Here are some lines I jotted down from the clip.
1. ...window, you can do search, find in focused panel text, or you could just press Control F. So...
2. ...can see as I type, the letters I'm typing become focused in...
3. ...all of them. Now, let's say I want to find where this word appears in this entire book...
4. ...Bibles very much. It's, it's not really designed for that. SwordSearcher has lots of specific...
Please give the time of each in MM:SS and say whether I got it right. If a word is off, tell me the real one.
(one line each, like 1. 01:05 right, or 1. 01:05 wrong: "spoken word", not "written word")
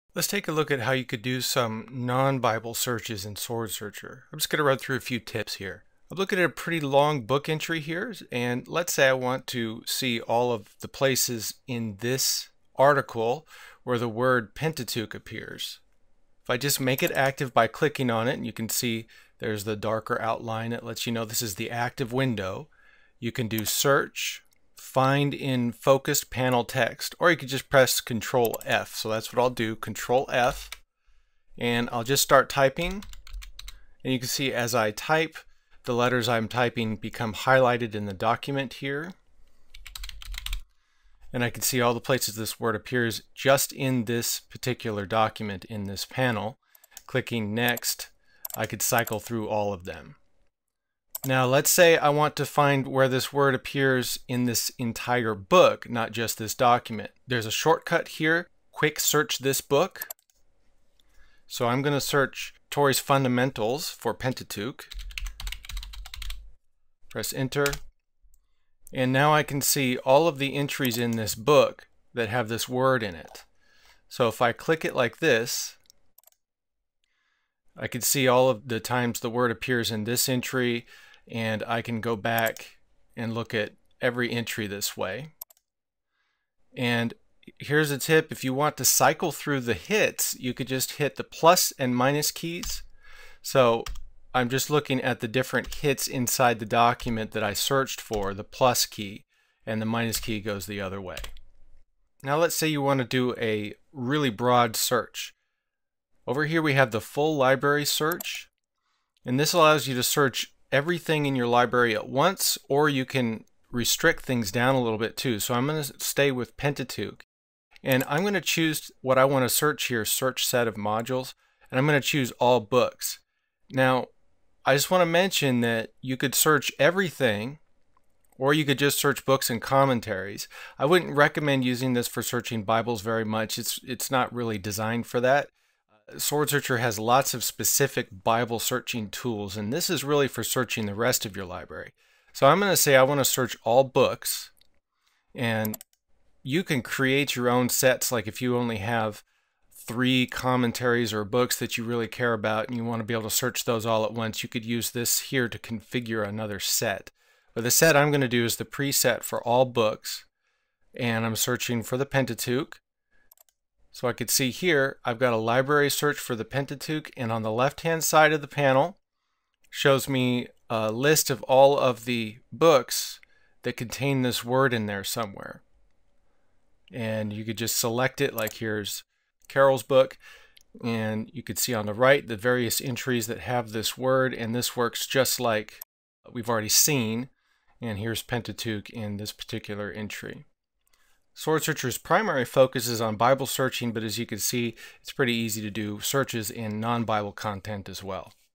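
1. 00:22 right
2. 00:34 wrong: "highlighted", not "focused"
3. 00:49 right
4. 02:12 right.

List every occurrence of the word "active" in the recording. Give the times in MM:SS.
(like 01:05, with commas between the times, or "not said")
00:17, 00:21.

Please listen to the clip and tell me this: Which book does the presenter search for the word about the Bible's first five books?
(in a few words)
Torrey's Fundamentals.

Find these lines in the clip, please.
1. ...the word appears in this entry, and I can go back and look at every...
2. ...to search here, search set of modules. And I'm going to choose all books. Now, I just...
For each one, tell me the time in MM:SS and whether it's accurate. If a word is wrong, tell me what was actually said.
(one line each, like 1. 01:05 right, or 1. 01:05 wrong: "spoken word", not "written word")
1. 01:19 right
2. 01:59 right.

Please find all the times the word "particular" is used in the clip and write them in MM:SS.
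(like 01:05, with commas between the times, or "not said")
00:44, 03:09.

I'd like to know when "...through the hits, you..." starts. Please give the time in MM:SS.
01:29.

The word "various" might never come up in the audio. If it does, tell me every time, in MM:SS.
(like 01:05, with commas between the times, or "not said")
03:02.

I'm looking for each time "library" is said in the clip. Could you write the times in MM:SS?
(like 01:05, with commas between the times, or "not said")
01:47, 01:51, 02:21, 02:45.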